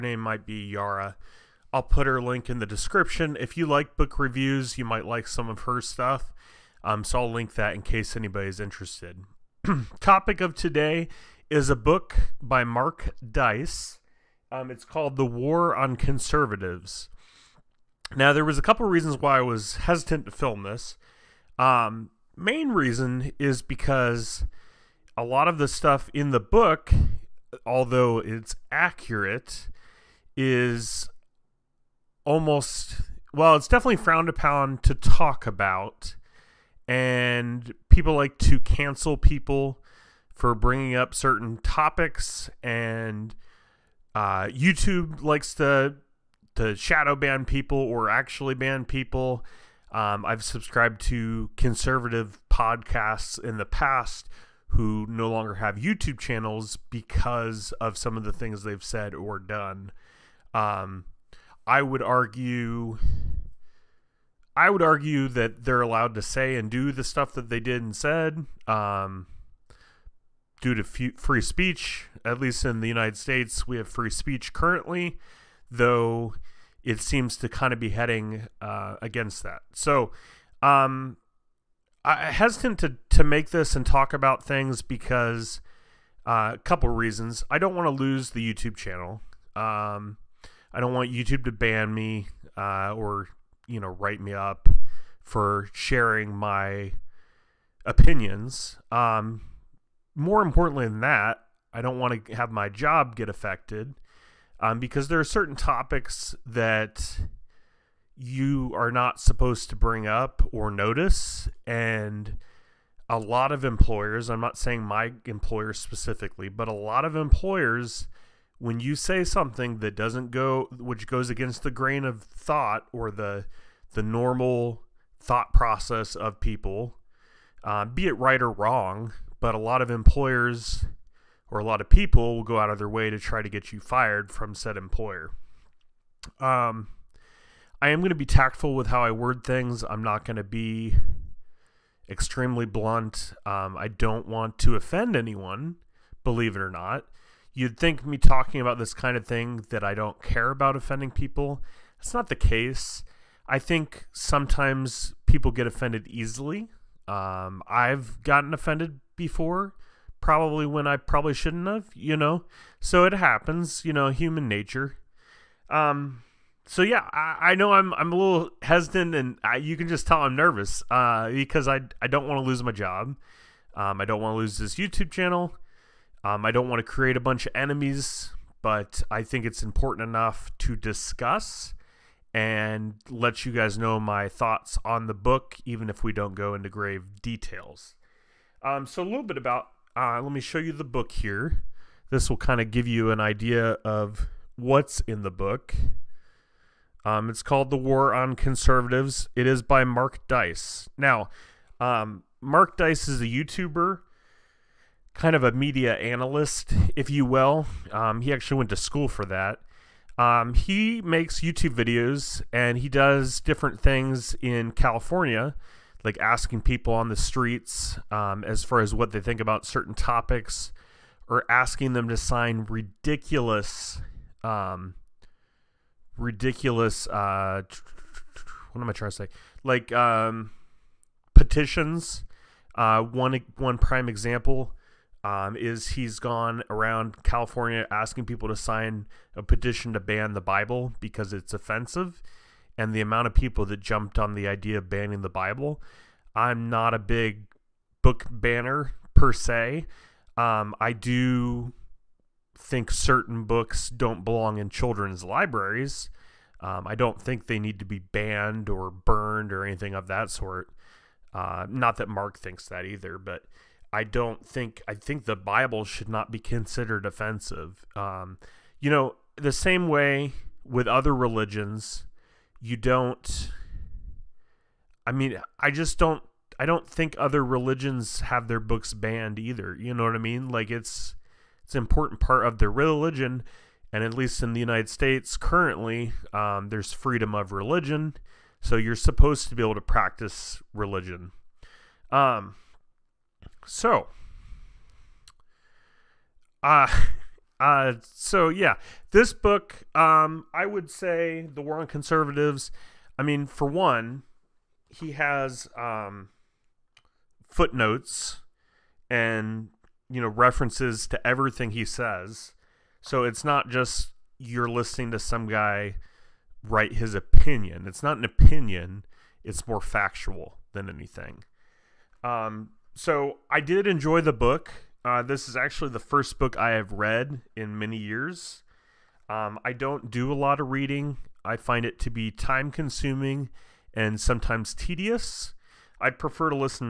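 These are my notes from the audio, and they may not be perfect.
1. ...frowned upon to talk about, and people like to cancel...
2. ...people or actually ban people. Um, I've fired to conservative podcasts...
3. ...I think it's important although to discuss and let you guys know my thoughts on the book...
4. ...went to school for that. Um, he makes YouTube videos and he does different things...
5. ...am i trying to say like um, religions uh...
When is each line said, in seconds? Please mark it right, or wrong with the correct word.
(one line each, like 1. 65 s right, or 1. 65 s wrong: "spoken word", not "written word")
1. 33 s right
2. 47 s wrong: "subscribed", not "fired"
3. 179 s wrong: "enough", not "although"
4. 208 s right
5. 228 s wrong: "petitions", not "religions".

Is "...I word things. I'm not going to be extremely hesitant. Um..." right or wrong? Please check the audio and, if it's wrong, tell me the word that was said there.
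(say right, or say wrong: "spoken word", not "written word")
wrong: "blunt", not "hesitant".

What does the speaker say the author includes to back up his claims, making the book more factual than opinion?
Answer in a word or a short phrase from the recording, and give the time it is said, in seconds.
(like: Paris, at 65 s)
Footnotes, at 307 s.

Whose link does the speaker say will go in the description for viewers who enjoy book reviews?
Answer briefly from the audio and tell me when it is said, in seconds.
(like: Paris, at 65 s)
Yara, at 0 s.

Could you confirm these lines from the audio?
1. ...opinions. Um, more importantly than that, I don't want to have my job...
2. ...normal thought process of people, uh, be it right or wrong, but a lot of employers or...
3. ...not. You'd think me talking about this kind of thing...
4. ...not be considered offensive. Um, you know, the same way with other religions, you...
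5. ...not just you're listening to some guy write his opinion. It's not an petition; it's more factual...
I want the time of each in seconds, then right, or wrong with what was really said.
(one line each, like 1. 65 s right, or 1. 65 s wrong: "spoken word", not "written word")
1. 97 s right
2. 124 s right
3. 146 s right
4. 266 s right
5. 313 s wrong: "opinion", not "petition".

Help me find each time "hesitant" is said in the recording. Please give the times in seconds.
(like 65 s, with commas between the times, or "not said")
19 s, 82 s, 168 s.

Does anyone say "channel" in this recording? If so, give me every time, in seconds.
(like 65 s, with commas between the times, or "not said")
56 s, 88 s, 175 s.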